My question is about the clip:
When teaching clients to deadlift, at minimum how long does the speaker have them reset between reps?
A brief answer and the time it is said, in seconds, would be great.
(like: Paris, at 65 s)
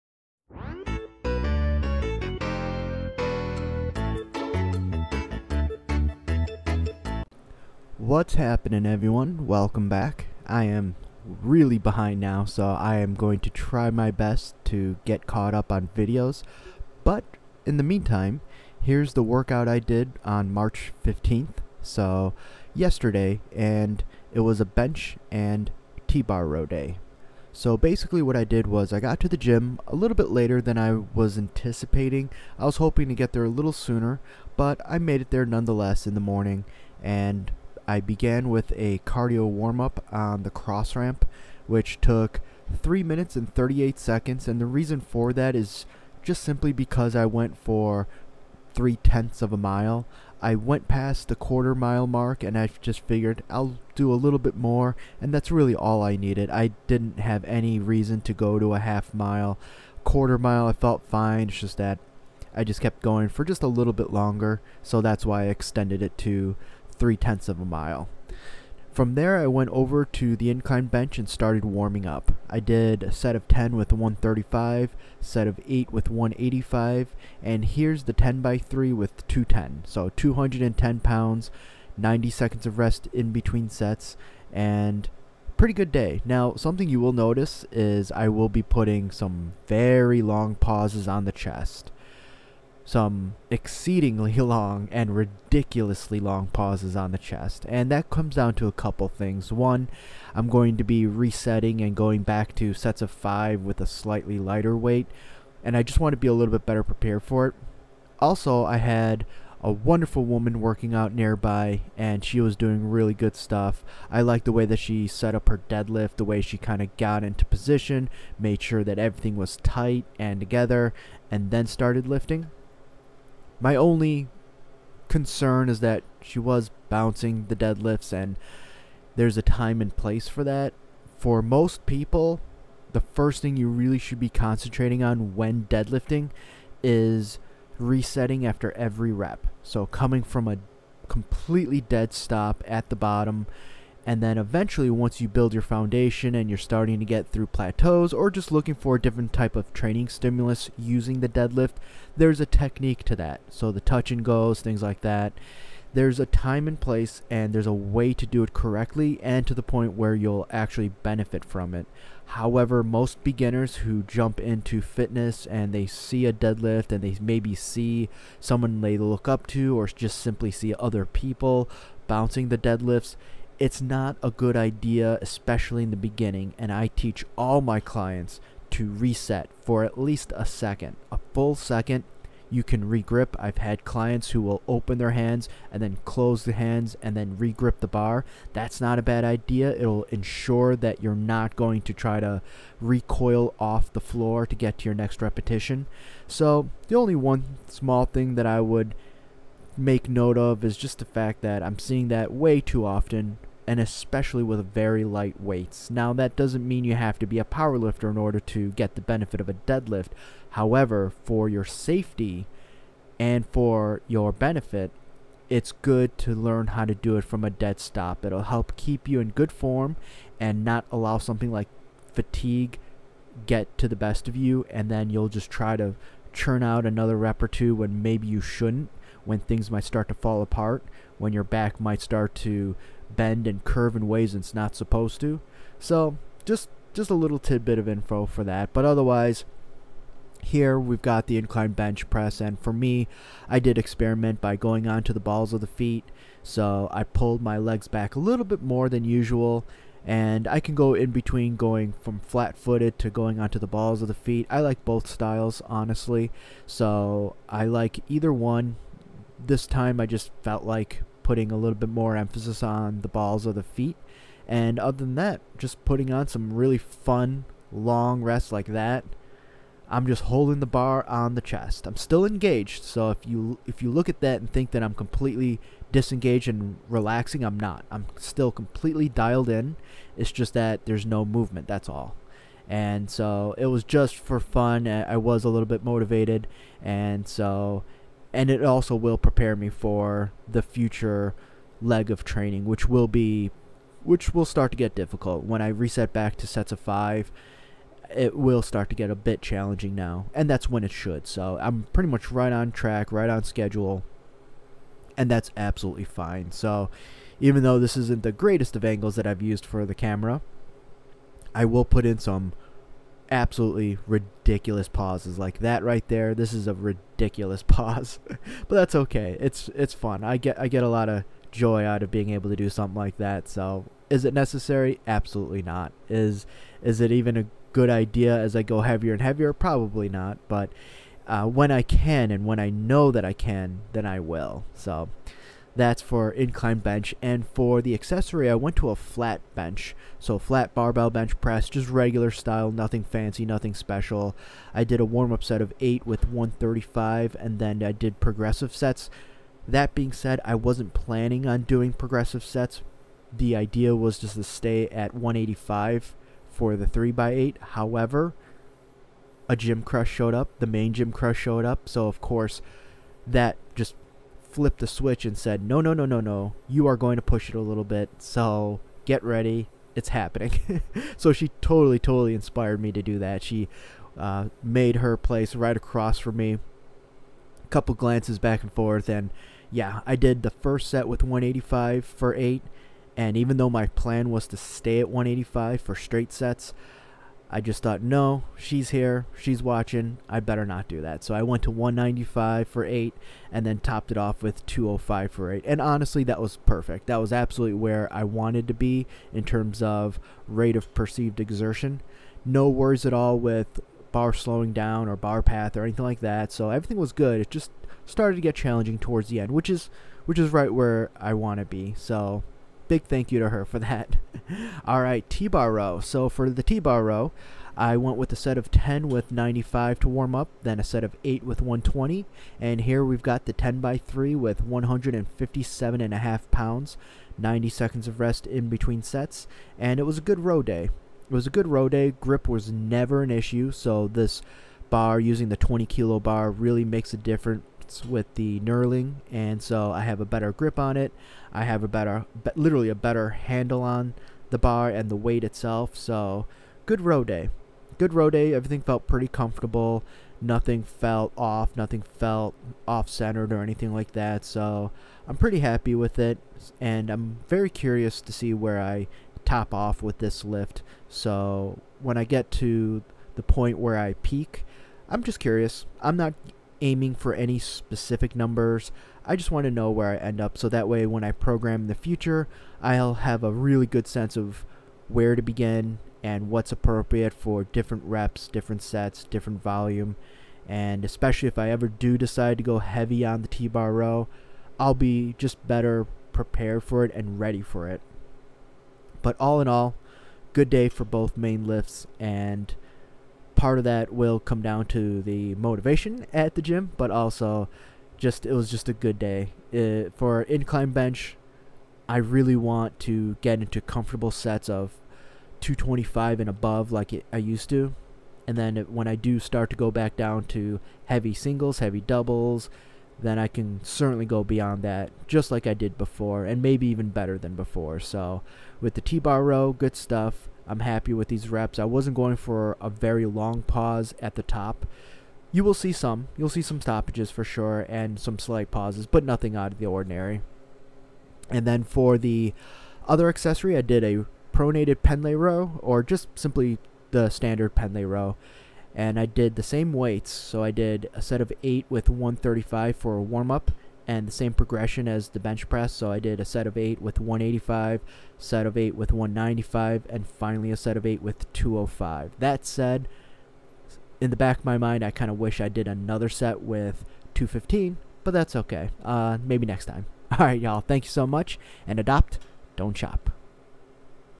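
a full second, at 181 s.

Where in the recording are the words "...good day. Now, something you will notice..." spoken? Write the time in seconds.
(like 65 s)
85 s.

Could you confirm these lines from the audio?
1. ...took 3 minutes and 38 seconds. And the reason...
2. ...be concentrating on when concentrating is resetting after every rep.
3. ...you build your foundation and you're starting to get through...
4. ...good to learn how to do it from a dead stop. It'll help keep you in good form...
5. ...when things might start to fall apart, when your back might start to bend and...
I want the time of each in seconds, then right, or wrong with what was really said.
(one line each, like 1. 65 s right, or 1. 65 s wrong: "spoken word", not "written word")
1. 41 s right
2. 134 s wrong: "deadlifting", not "concentrating"
3. 145 s right
4. 215 s right
5. 229 s right.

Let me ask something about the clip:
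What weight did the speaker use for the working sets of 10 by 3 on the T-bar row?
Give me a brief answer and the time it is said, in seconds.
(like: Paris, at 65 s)
157.5 pounds, at 424 s.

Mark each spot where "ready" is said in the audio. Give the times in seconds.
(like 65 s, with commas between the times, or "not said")
369 s, 487 s.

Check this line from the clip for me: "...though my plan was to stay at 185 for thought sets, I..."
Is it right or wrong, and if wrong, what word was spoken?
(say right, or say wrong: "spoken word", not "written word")
wrong: "straight", not "thought".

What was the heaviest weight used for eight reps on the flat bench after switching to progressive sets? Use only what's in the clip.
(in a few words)
205.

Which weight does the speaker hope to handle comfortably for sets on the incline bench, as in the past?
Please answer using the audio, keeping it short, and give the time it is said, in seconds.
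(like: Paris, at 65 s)
225, at 505 s.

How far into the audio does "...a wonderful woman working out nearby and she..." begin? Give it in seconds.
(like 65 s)
109 s.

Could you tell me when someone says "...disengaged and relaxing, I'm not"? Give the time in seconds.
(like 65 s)
275 s.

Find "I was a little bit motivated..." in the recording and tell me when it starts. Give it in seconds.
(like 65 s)
284 s.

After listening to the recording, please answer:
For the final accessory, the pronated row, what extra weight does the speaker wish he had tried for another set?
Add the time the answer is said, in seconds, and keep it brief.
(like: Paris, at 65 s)
215, at 557 s.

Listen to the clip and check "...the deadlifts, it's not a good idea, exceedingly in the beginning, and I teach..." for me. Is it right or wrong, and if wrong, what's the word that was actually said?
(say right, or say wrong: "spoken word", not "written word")
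wrong: "especially", not "exceedingly".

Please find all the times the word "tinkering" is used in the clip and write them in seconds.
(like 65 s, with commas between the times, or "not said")
not said.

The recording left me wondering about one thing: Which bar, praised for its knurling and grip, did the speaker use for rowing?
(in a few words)
20 kilo bar.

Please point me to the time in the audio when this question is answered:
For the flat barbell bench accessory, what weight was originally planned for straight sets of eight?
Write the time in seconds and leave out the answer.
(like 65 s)
355 s.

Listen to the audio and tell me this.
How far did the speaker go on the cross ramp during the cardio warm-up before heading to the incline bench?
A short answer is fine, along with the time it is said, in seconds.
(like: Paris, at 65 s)
3 tenths of a mile, at 48 s.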